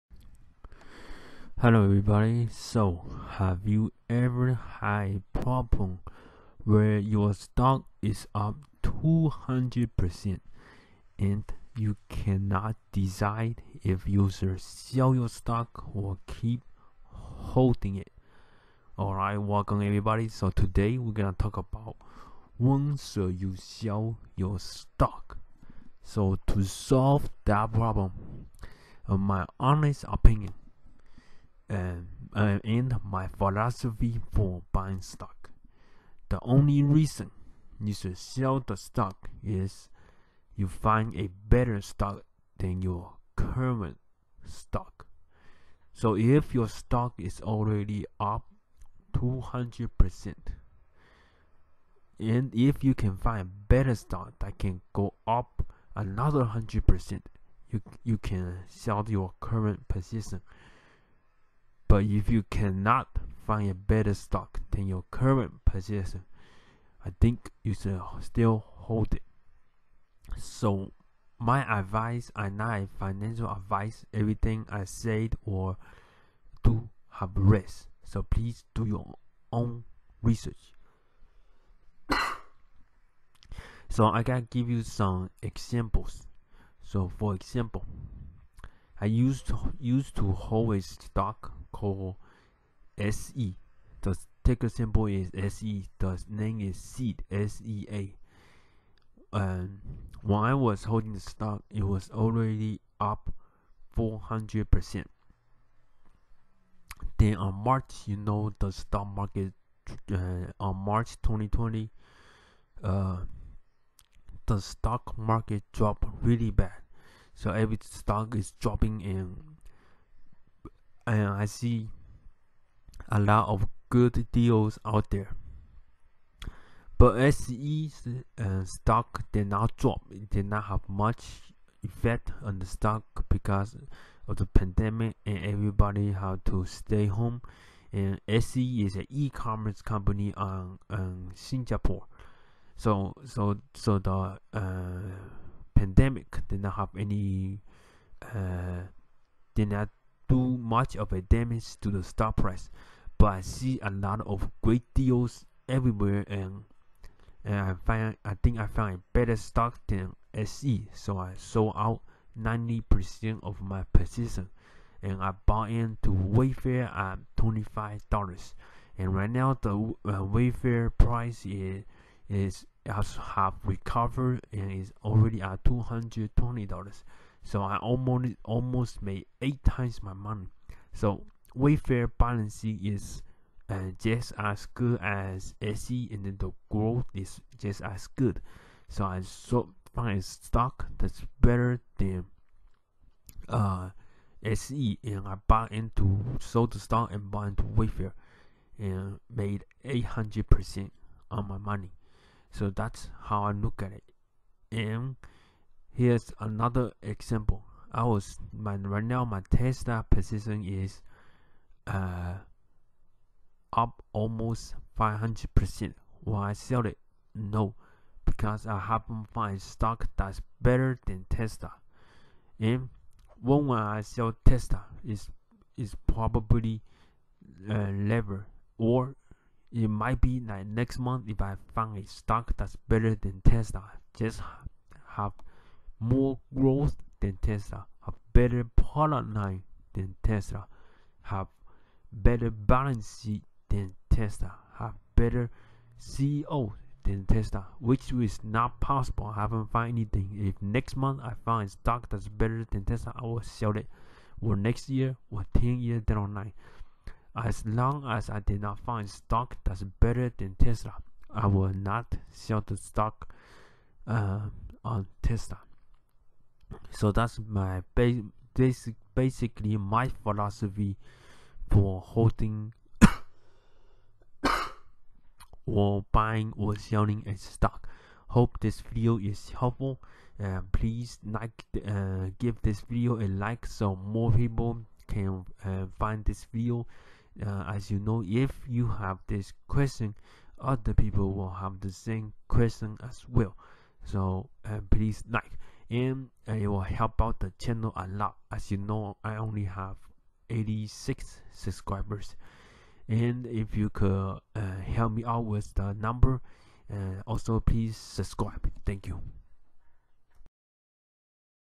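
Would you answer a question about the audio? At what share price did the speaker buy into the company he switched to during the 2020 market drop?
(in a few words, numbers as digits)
$25.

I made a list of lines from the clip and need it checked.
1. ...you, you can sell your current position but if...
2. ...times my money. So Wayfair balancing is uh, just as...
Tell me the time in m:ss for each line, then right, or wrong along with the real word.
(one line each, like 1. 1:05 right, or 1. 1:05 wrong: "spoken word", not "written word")
1. 0:57 right
2. 2:59 right.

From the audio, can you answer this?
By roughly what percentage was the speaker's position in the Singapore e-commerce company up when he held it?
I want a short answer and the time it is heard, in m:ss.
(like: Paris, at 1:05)
400%, at 1:43.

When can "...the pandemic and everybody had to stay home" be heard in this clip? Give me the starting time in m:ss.
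2:14.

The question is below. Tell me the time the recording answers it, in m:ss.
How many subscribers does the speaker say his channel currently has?
5:00.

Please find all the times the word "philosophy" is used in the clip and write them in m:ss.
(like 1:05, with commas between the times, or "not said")
0:33, 4:30.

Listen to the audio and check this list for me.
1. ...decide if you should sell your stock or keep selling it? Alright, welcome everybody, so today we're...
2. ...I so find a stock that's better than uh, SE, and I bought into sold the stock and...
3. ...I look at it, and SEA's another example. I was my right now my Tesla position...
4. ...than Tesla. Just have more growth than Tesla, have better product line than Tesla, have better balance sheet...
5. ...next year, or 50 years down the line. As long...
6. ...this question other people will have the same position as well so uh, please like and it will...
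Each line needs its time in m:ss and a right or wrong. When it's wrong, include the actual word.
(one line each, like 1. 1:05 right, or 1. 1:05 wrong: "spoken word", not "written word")
1. 0:12 wrong: "holding", not "selling"
2. 3:09 right
3. 3:23 wrong: "Here", not "SEA"
4. 3:53 right
5. 4:14 wrong: "10", not "50"
6. 4:49 wrong: "question", not "position".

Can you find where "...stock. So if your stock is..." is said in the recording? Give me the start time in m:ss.
0:44.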